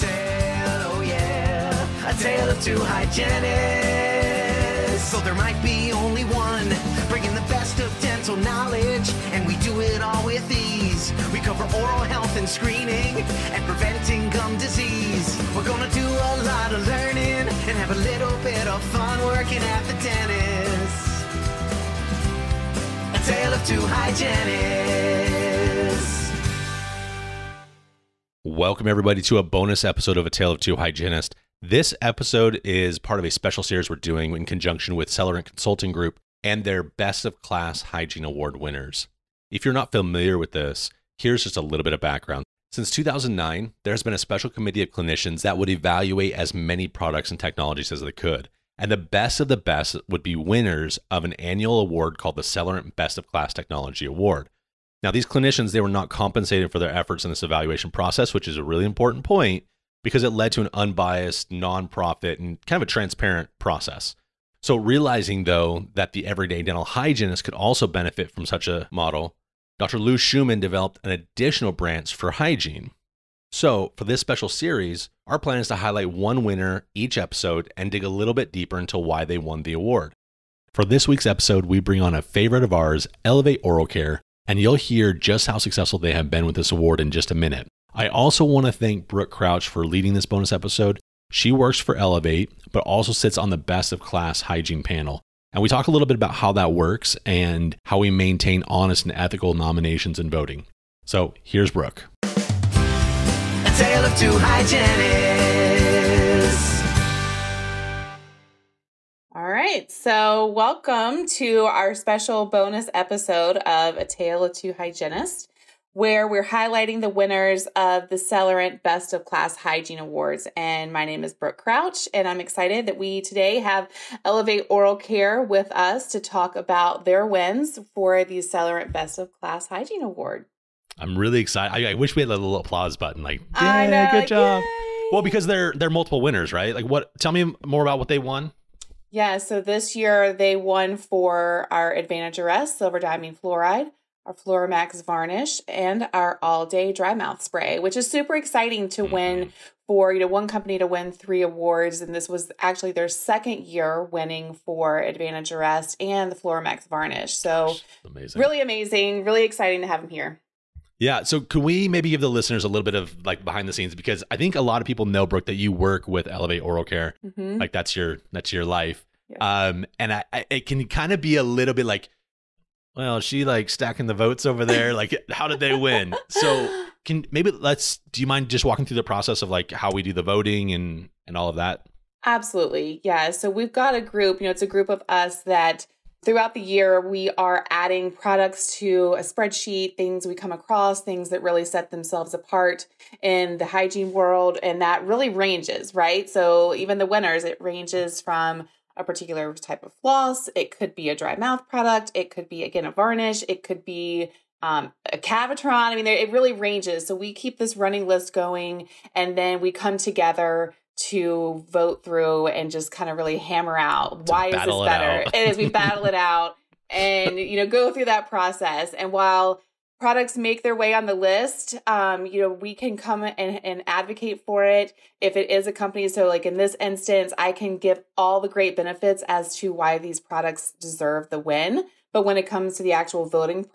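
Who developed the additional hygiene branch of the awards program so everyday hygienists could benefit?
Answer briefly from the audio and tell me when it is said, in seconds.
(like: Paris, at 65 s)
Dr. Lou Schumann, at 69 s.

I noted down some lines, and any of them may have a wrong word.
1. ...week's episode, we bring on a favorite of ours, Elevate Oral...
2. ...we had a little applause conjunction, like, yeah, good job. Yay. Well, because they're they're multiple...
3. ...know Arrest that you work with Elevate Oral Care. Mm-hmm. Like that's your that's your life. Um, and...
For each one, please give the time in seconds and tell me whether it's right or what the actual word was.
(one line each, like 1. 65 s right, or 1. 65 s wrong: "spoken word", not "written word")
1. 81 s right
2. 132 s wrong: "button", not "conjunction"
3. 165 s wrong: "Brooke", not "Arrest".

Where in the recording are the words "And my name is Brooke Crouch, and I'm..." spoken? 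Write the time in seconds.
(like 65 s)
120 s.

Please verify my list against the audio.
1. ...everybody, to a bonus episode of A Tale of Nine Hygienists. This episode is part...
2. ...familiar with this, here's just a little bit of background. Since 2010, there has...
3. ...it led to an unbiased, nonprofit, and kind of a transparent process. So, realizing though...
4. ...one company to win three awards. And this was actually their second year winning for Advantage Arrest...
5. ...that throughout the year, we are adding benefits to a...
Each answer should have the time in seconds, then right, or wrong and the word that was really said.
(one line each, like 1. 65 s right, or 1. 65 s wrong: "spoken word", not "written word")
1. 28 s wrong: "Two", not "Nine"
2. 39 s wrong: "2009", not "2010"
3. 60 s right
4. 150 s right
5. 185 s wrong: "products", not "benefits".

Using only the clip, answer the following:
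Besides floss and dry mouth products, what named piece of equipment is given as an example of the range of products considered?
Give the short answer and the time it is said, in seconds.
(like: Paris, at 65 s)
Cavitron, at 205 s.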